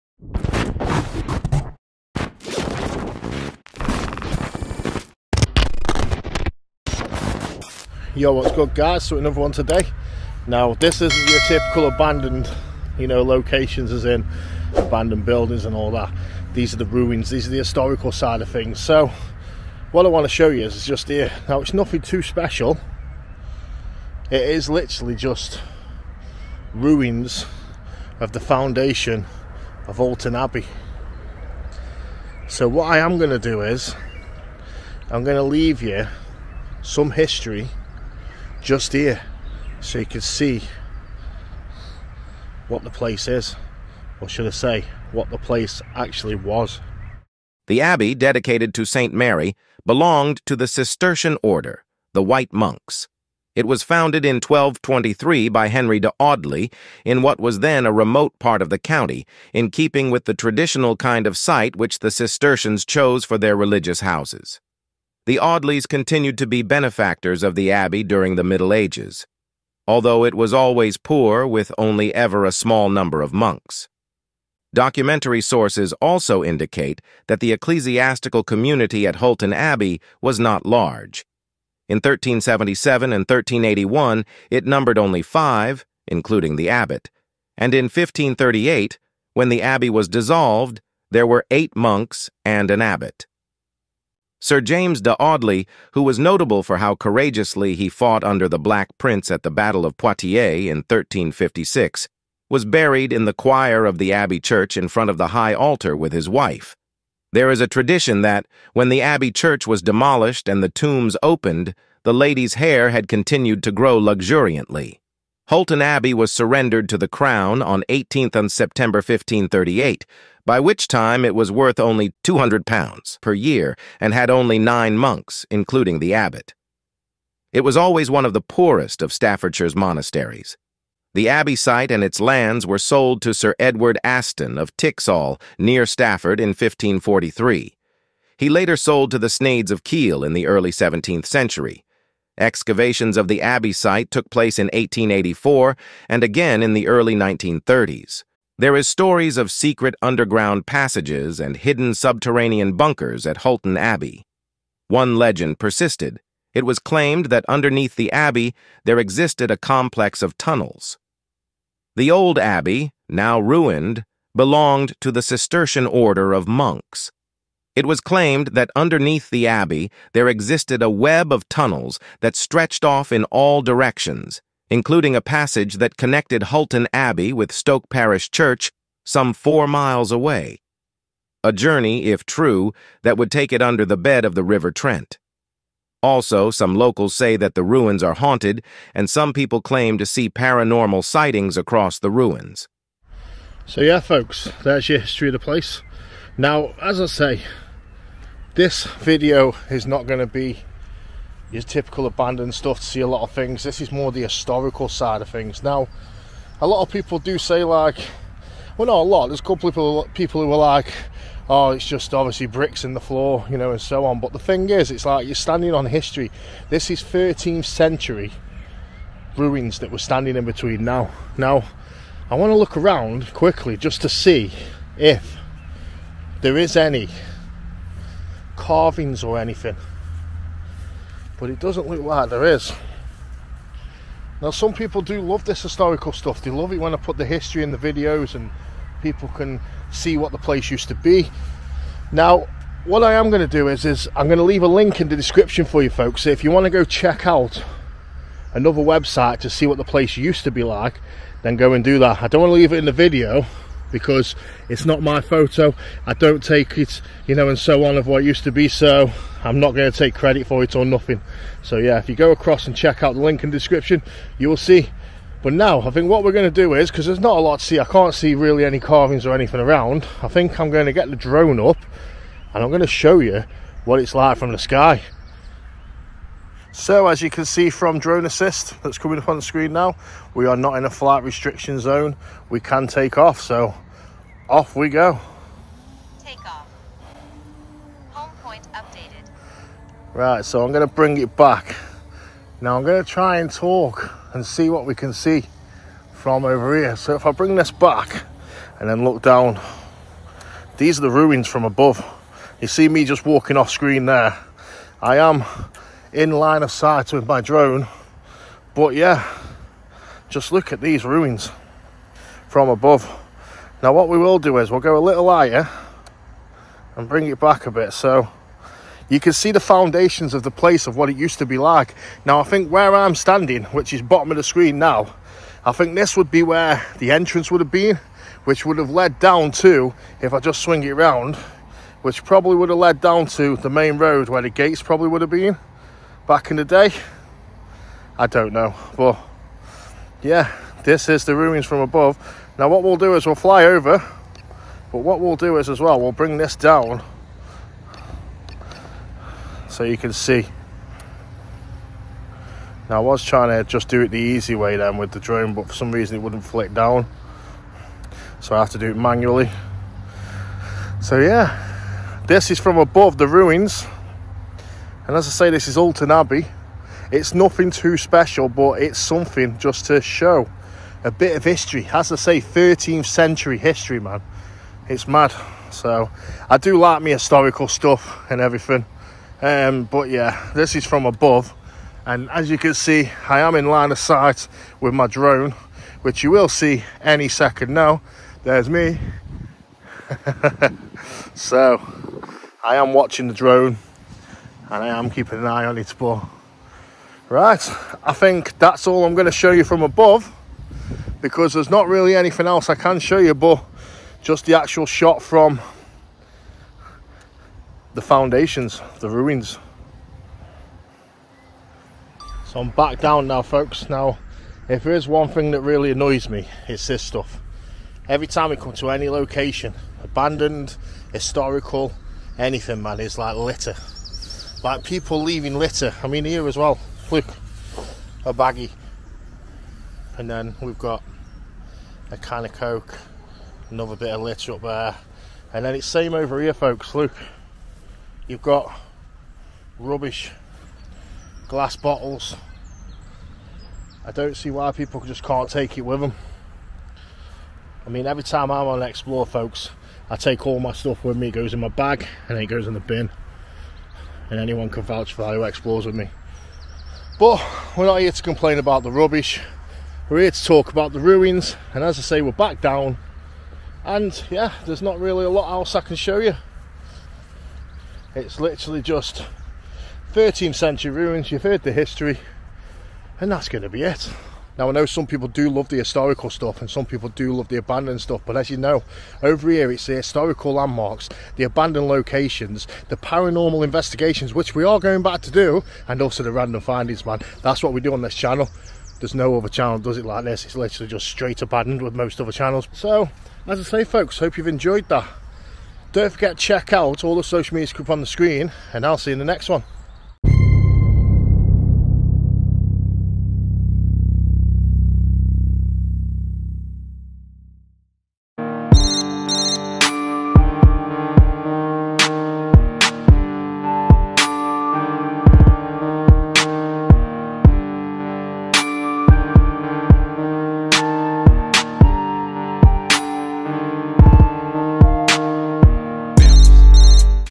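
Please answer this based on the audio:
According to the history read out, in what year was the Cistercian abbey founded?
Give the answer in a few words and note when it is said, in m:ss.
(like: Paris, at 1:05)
1223, at 0:54.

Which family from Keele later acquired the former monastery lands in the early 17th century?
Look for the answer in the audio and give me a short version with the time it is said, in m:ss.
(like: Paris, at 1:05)
The Sneyds, at 2:19.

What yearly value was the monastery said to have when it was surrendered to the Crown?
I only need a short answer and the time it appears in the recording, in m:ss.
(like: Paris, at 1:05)
£200, at 2:02.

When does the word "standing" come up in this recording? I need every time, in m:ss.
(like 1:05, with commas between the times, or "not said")
3:35, 3:39, 5:23.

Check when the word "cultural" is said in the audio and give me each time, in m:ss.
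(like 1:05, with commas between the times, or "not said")
not said.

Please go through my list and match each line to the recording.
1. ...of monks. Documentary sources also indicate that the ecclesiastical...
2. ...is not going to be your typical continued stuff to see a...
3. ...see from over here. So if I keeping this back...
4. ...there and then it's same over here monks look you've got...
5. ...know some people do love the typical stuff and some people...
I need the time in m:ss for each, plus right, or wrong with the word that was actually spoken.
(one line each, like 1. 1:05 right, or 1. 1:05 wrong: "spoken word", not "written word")
1. 1:13 right
2. 3:19 wrong: "abandoned", not "continued"
3. 4:55 wrong: "bring", not "keeping"
4. 7:14 wrong: "folks", not "monks"
5. 7:54 wrong: "historical", not "typical".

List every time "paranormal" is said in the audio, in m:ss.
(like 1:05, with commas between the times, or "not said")
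3:10, 8:02.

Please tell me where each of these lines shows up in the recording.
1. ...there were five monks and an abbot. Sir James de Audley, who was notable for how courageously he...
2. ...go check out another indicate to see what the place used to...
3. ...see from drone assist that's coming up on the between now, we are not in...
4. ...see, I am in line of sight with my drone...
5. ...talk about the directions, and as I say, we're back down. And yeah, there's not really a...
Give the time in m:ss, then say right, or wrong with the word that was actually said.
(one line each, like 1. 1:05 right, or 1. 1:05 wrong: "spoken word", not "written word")
1. 1:31 wrong: "eight", not "five"
2. 4:06 wrong: "website", not "indicate"
3. 4:37 wrong: "screen", not "between"
4. 6:22 right
5. 7:40 wrong: "ruins", not "directions".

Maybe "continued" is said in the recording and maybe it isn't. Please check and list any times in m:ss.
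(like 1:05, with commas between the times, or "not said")
1:05, 1:53.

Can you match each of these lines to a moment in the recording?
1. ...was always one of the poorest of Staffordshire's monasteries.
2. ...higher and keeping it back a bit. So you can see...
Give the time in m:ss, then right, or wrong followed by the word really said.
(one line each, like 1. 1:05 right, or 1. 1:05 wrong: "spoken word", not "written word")
1. 2:07 right
2. 5:15 wrong: "bring", not "keeping".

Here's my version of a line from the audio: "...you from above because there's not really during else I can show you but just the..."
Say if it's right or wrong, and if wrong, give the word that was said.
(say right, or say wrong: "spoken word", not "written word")
wrong: "anything", not "during".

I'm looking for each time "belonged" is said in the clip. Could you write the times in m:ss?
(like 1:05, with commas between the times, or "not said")
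0:49, 2:44.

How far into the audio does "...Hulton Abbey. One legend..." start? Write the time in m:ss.
2:33.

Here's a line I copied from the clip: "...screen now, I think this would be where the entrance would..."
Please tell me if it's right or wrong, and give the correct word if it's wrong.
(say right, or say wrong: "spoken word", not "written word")
right.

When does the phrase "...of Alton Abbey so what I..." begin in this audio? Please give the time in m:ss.
0:29.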